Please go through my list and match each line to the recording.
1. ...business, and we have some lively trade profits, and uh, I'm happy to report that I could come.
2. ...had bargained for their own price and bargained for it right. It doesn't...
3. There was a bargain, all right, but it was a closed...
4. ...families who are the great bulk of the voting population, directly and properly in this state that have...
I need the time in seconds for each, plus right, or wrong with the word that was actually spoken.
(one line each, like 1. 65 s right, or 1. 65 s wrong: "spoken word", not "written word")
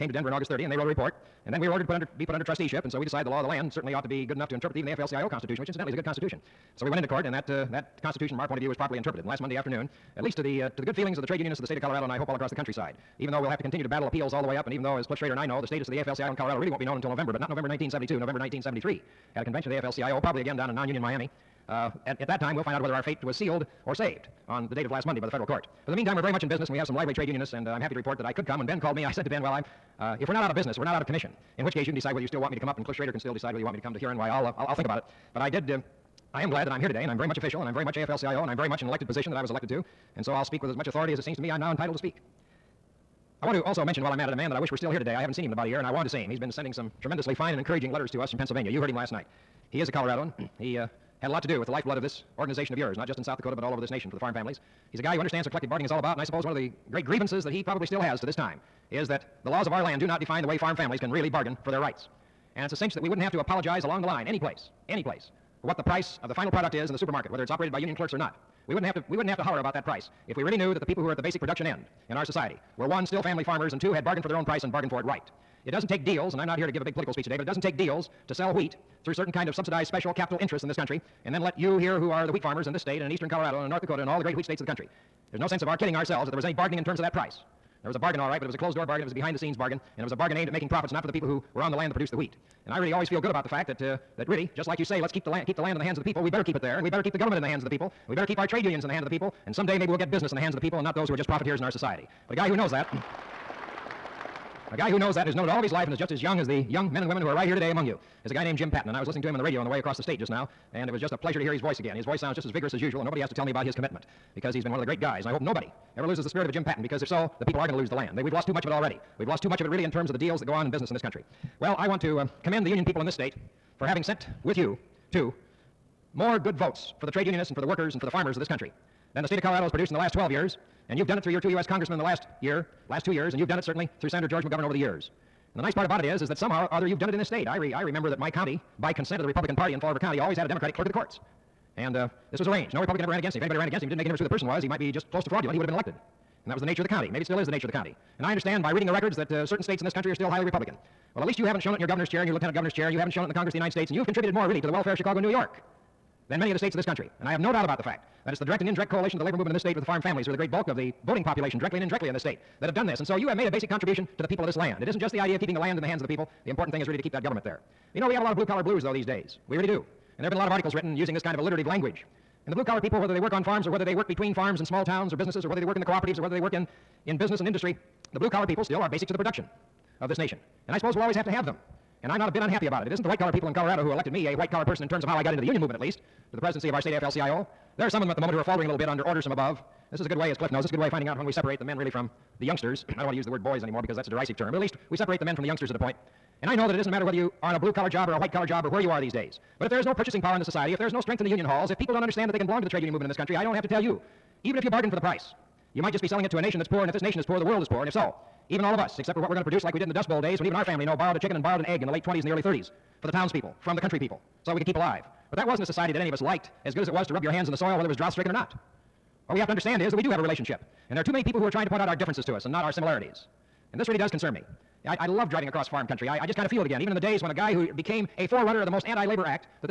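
1. 26 s wrong: "unionists", not "profits"
2. 73 s right
3. 87 s right
4. 159 s wrong: "indirectly", not "properly".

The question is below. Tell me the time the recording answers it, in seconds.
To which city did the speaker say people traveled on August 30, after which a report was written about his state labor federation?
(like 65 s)
0 s.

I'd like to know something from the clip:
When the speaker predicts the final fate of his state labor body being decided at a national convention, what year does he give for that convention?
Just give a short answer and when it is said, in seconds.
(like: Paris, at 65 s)
1973, at 18 s.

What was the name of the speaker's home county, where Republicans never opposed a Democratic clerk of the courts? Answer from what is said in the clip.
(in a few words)
Fall River County.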